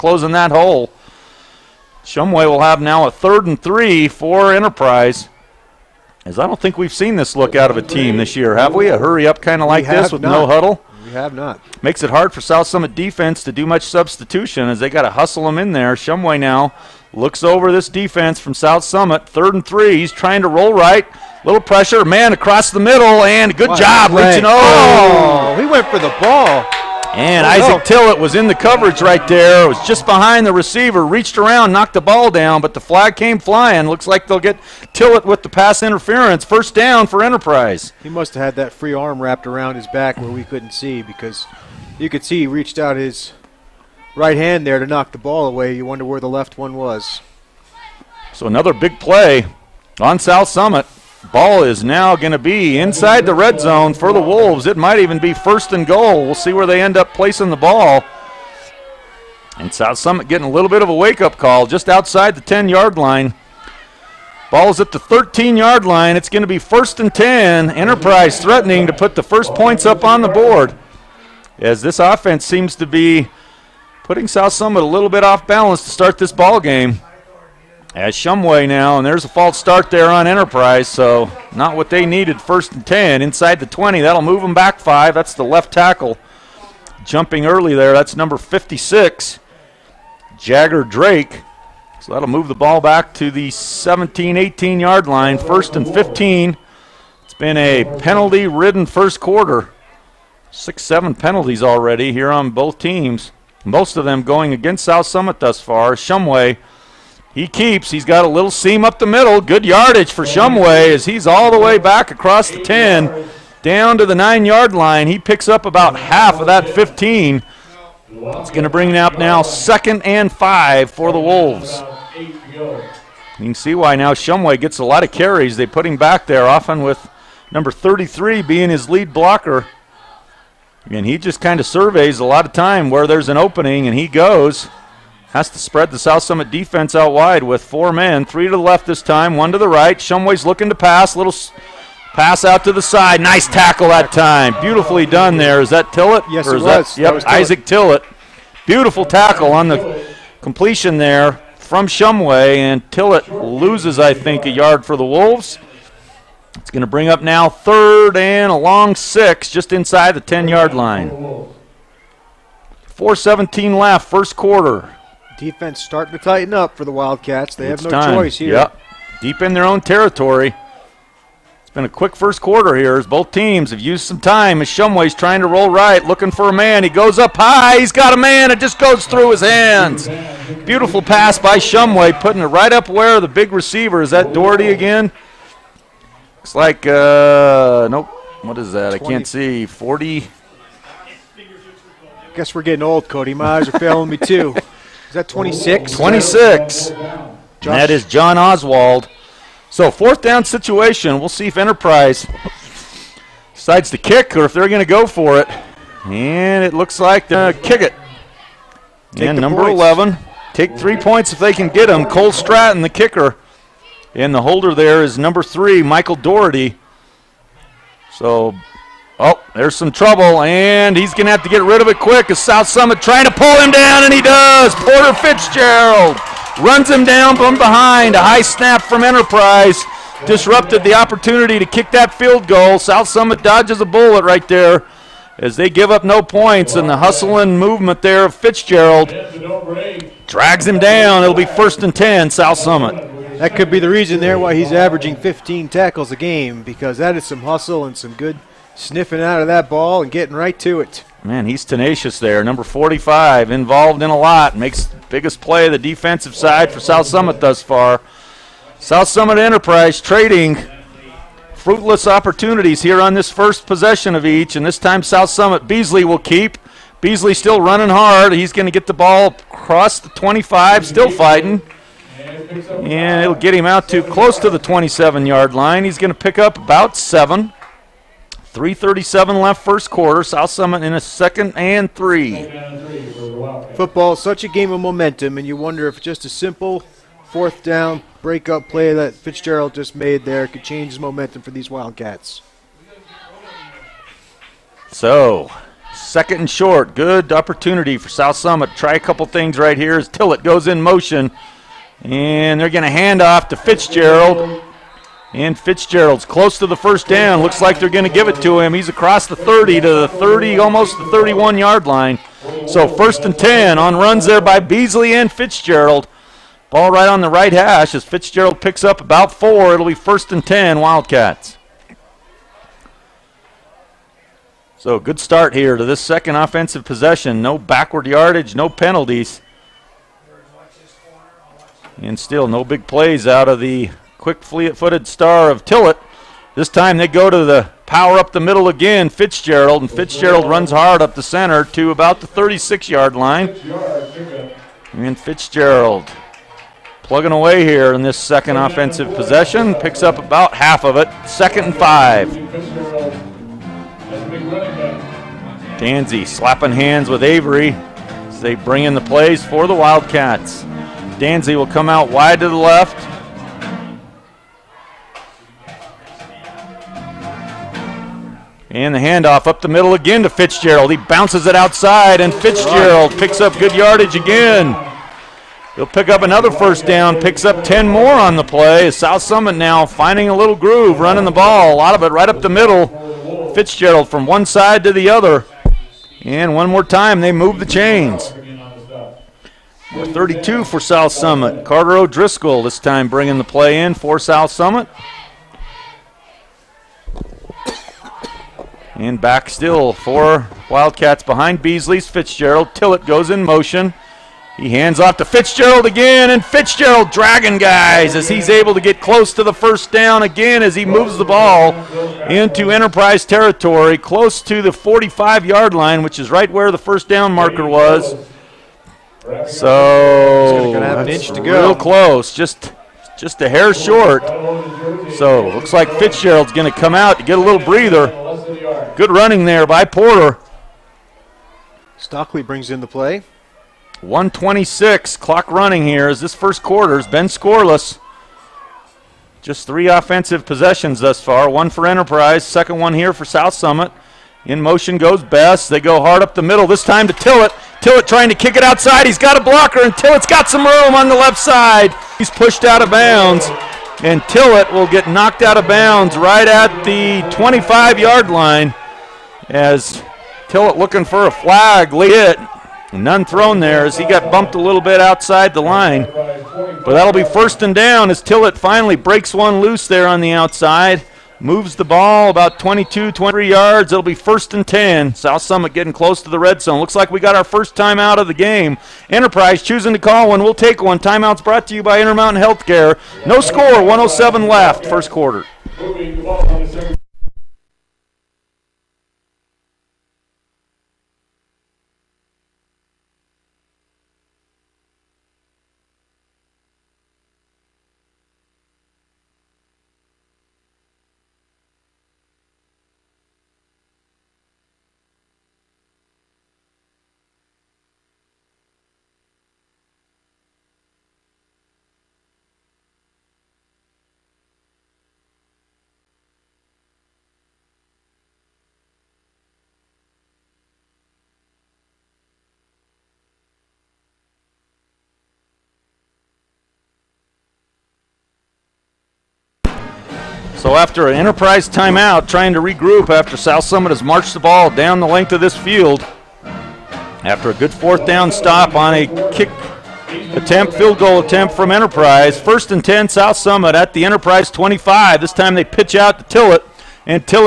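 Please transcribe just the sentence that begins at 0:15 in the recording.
Shumway now looks over this defense from South Summit.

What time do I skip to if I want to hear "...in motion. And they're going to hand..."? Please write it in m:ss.
5:00.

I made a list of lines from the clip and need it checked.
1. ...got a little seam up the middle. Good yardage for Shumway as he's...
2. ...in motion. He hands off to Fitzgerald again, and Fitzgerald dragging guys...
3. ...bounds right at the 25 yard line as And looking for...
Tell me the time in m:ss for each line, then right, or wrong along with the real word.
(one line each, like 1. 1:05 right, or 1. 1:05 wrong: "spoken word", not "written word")
1. 1:48 right
2. 6:43 right
3. 7:35 wrong: "Tillett", not "And".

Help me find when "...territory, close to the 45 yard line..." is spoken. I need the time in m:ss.
6:53.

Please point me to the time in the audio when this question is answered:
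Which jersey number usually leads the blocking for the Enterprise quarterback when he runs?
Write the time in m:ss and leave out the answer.
2:07.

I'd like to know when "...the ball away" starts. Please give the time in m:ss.
0:45.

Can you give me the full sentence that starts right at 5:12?
So first and 10 on runs there by Beasley and Fitzgerald.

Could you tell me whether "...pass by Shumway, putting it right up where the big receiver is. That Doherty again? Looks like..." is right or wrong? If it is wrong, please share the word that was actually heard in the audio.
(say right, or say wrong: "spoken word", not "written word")
right.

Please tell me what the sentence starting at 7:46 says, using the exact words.
But that'll be first and down as Tillett finally breaks one loose there on the outside.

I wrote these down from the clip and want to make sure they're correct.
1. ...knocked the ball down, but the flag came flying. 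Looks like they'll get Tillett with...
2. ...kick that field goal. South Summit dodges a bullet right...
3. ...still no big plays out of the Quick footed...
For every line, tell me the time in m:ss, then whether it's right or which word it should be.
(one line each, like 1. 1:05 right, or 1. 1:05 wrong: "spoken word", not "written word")
1. 0:31 right
2. 3:51 right
3. 5:32 right.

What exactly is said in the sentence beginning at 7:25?
They go hard up the middle, this time to Tillett.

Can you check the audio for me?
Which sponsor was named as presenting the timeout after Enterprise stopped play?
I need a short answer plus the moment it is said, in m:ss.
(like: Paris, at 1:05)
Intermountain Healthcare, at 8:01.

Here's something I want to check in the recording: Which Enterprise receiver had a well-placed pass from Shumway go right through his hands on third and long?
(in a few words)
John Oswald.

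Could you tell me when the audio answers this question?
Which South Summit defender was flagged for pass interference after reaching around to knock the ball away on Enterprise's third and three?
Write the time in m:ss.
0:27.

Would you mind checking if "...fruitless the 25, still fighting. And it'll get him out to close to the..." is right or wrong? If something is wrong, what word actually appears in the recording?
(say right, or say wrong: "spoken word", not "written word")
wrong: "across", not "fruitless".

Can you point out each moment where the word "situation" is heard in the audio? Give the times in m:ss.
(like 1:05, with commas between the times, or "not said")
3:20.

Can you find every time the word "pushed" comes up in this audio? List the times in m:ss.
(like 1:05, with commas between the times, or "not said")
7:32.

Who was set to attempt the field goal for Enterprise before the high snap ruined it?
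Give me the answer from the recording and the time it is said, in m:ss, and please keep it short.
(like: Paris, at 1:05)
Cole Stratton, at 3:32.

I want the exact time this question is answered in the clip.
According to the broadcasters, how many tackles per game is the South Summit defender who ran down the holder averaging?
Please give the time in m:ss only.
4:05.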